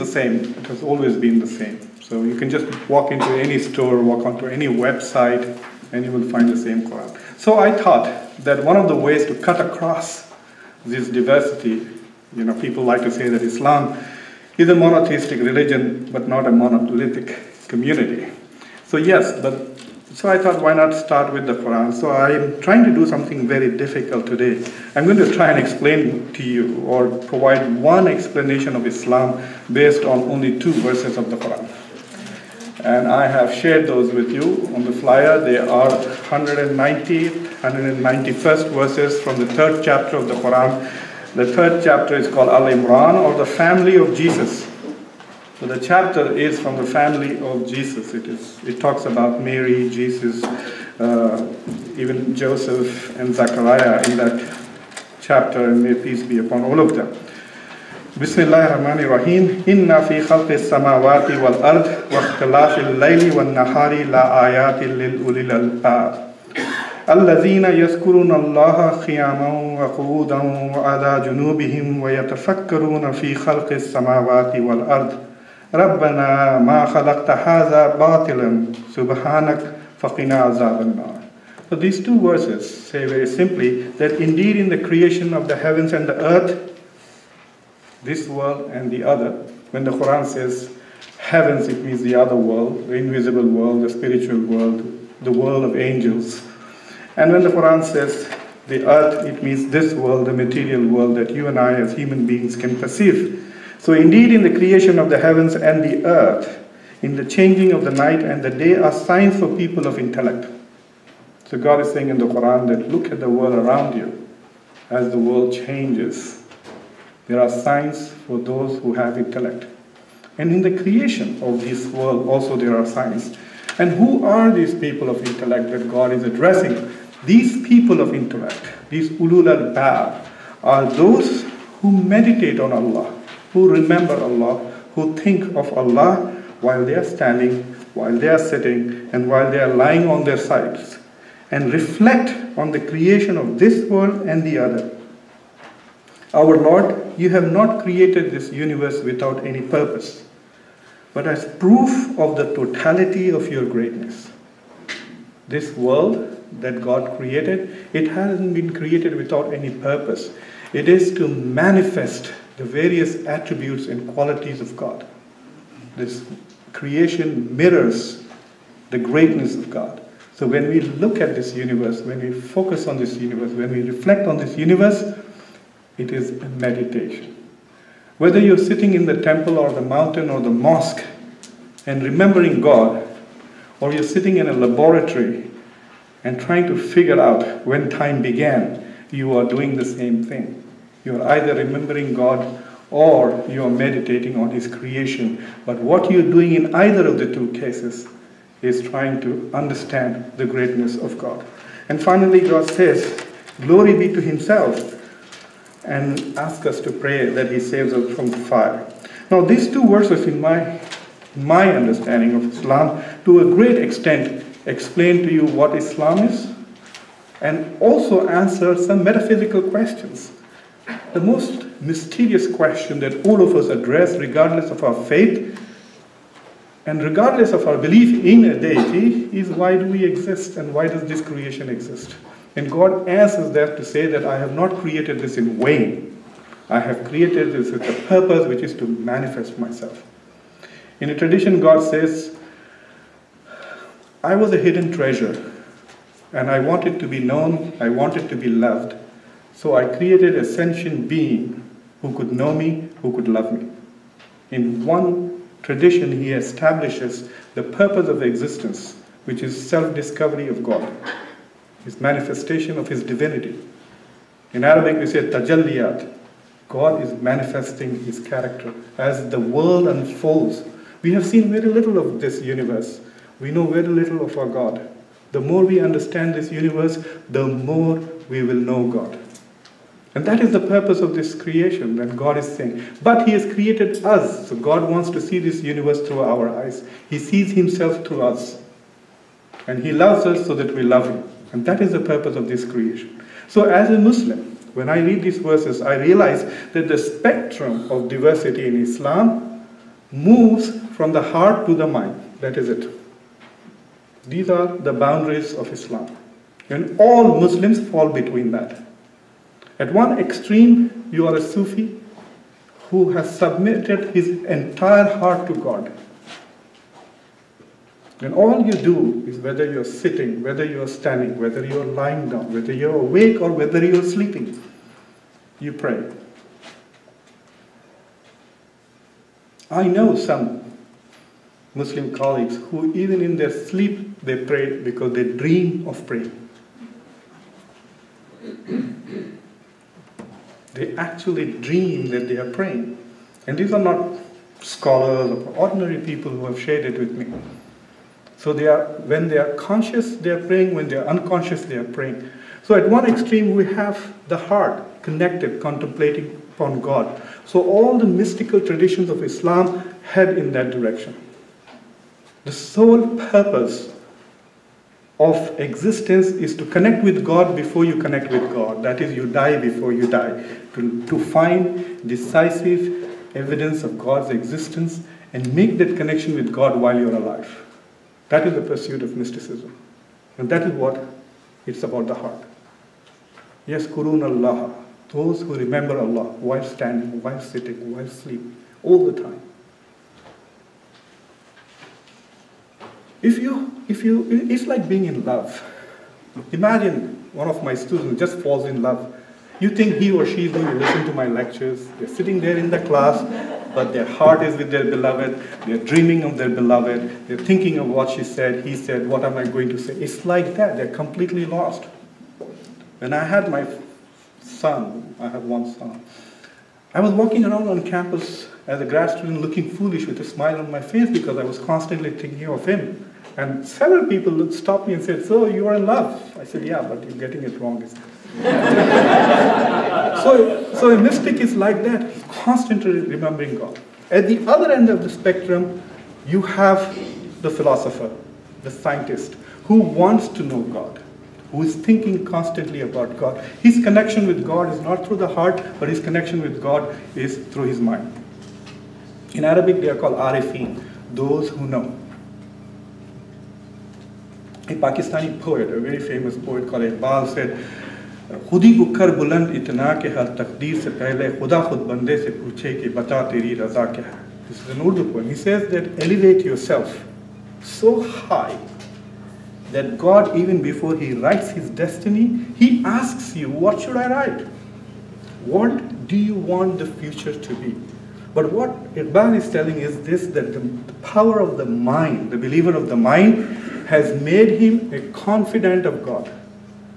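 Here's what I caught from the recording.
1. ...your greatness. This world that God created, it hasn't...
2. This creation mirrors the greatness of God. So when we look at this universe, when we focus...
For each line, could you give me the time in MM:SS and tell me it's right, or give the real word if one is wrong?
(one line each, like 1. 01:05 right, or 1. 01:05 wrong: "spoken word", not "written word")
1. 02:33 right
2. 02:45 right.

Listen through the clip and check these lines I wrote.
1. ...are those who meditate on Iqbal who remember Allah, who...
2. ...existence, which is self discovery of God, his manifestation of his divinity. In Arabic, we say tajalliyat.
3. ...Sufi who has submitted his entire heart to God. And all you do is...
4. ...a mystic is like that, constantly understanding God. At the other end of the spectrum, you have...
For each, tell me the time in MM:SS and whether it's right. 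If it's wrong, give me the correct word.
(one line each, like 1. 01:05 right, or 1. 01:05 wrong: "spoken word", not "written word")
1. 02:10 wrong: "Allah", not "Iqbal"
2. 04:18 right
3. 05:11 right
4. 07:10 wrong: "remembering", not "understanding".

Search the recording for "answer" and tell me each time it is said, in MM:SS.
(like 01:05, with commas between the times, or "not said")
03:38, 03:53.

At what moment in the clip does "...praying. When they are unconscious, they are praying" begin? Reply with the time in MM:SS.
05:50.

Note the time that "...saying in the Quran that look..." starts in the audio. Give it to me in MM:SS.
01:51.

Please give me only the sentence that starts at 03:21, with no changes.
And finally, God says, Glory be to Himself, and ask us to pray that He saves us from the fire.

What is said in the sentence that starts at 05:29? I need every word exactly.
I know some Muslim colleagues who, even in their sleep, they pray because they dream of praying.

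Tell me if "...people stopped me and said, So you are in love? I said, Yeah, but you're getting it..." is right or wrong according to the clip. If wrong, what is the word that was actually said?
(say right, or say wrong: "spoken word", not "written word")
right.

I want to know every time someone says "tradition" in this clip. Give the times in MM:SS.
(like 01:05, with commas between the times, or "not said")
04:01, 04:15, 05:58.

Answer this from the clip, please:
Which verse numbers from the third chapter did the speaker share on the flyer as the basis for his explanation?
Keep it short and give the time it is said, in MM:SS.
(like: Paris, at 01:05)
190 and 191, at 00:35.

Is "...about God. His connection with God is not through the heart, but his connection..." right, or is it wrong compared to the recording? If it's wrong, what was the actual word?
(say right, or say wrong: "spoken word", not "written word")
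right.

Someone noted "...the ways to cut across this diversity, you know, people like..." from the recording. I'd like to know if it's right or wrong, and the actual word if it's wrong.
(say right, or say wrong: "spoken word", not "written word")
right.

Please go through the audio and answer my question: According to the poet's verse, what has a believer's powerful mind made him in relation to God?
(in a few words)
A confidant of God.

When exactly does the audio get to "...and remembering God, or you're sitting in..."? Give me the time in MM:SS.
03:01.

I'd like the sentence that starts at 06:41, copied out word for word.
They're sitting there in the class, but their heart is with their beloved.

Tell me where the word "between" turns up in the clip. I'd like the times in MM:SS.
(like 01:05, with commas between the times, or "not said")
05:08.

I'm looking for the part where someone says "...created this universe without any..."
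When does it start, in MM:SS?
02:27.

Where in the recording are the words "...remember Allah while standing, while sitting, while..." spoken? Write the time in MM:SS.
06:25.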